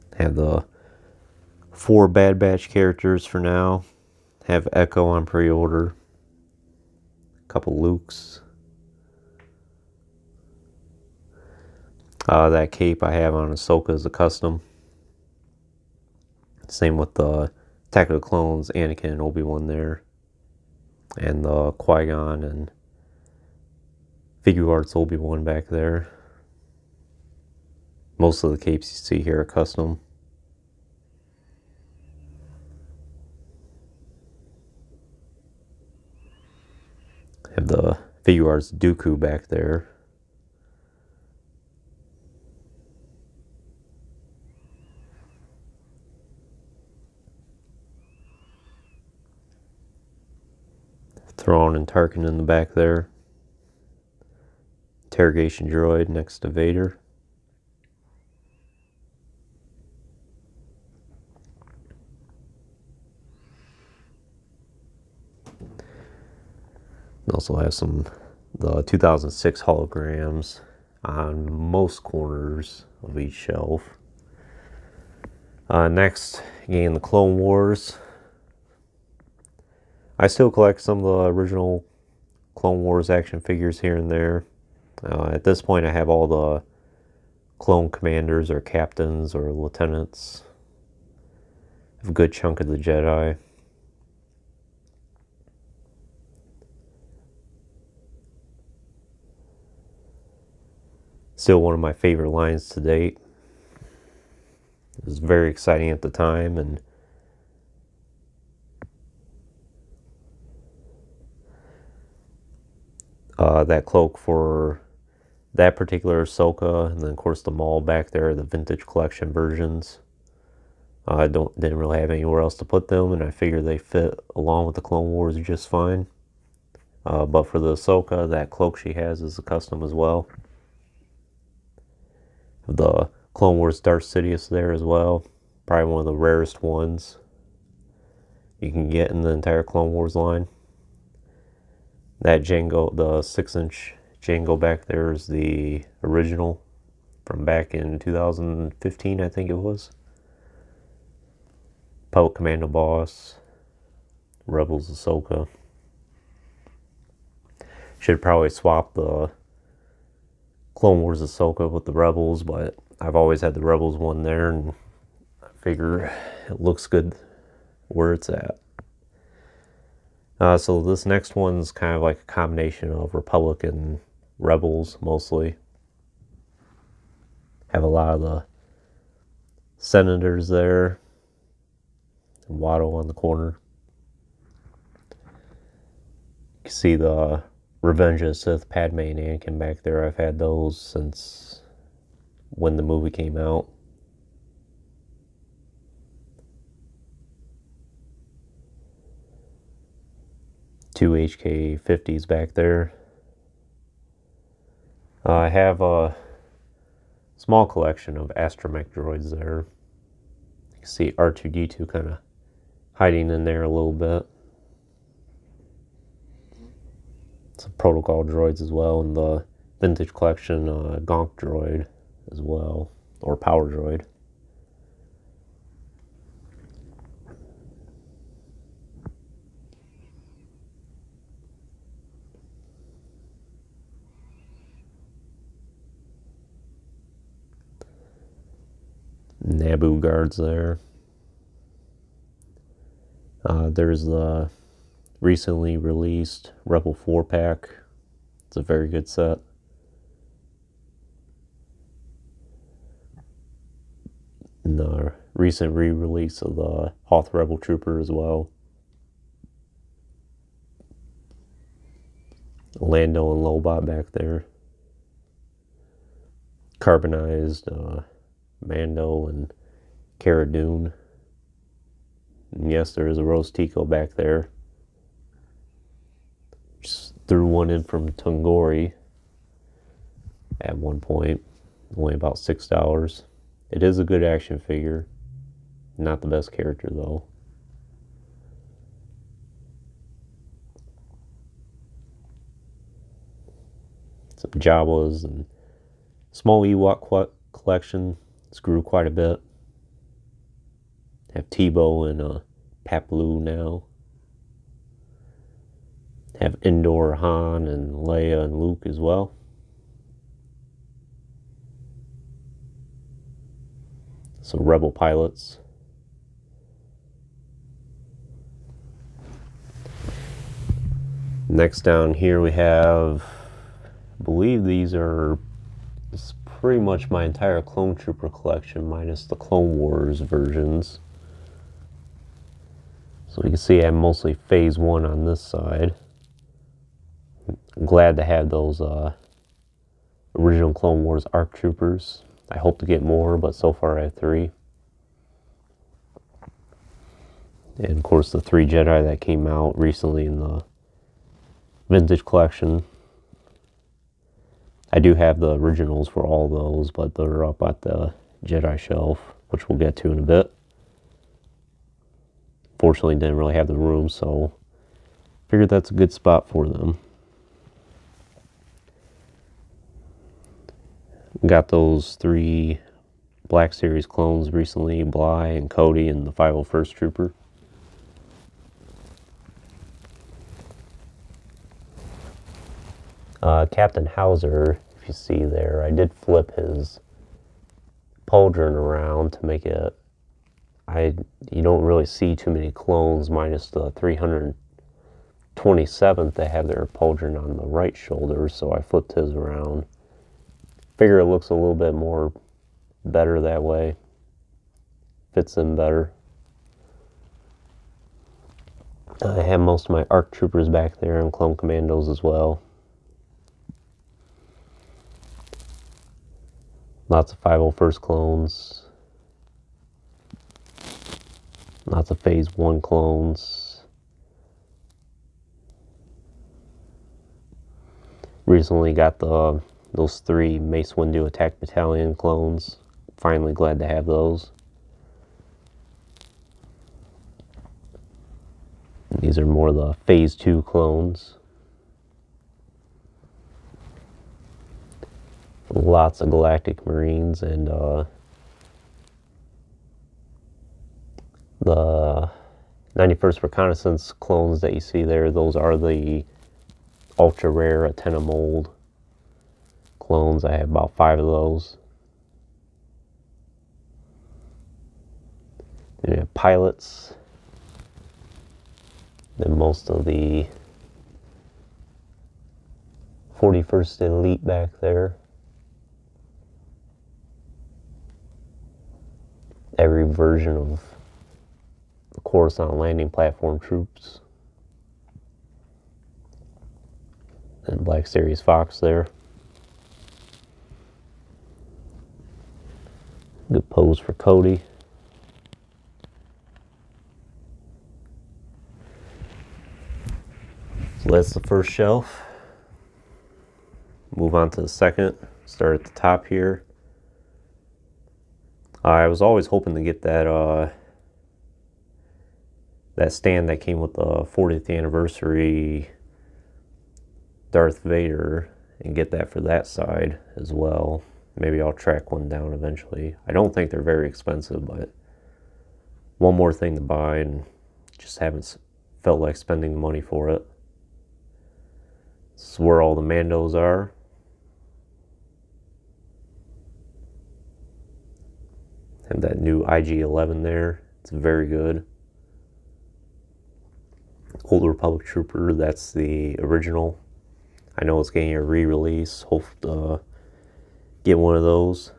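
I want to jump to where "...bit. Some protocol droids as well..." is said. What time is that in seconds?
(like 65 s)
213 s.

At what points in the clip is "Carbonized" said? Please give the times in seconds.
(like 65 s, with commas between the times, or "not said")
266 s.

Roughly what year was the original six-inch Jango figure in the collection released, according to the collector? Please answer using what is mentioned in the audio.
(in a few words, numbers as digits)
2015.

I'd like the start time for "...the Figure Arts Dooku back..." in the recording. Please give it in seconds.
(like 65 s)
37 s.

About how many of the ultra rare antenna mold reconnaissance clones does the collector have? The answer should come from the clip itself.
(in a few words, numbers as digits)
5.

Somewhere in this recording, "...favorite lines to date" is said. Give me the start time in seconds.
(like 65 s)
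101 s.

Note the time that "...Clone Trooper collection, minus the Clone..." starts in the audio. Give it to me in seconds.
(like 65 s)
327 s.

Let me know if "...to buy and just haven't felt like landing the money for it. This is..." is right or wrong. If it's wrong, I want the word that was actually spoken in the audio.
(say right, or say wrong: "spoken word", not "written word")
wrong: "spending", not "landing".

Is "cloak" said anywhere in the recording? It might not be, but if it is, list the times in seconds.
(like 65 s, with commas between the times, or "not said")
113 s, 128 s.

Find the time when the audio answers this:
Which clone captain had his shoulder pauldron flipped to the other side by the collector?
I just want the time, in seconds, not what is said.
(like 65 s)
383 s.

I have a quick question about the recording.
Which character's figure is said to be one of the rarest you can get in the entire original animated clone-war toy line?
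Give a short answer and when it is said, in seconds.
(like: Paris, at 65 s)
Darth Sidious, at 133 s.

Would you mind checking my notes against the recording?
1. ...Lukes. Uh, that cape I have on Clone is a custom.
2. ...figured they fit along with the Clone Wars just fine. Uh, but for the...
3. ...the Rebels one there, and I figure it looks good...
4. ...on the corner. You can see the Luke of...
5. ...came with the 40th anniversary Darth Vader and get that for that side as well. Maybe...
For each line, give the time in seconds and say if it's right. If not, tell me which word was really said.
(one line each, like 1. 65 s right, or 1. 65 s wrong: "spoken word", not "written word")
1. 7 s wrong: "Ahsoka", not "Clone"
2. 123 s right
3. 163 s right
4. 182 s wrong: "Revenge", not "Luke"
5. 513 s right.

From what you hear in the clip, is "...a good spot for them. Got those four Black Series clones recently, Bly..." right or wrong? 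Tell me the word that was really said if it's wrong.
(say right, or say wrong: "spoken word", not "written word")
wrong: "three", not "four".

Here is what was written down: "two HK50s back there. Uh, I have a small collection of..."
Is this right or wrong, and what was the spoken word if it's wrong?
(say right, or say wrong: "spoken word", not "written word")
right.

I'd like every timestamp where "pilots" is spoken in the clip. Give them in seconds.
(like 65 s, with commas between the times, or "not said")
314 s, 466 s.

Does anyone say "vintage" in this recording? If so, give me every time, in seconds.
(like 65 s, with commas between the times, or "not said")
118 s, 219 s, 351 s.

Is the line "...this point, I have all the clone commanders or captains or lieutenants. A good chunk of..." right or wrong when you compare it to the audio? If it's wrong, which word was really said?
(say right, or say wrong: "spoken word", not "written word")
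right.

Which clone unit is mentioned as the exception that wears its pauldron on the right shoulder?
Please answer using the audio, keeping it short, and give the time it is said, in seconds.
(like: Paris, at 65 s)
327th, at 393 s.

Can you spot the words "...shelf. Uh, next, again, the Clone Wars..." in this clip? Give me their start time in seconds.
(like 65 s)
73 s.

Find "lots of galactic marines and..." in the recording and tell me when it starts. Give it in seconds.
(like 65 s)
445 s.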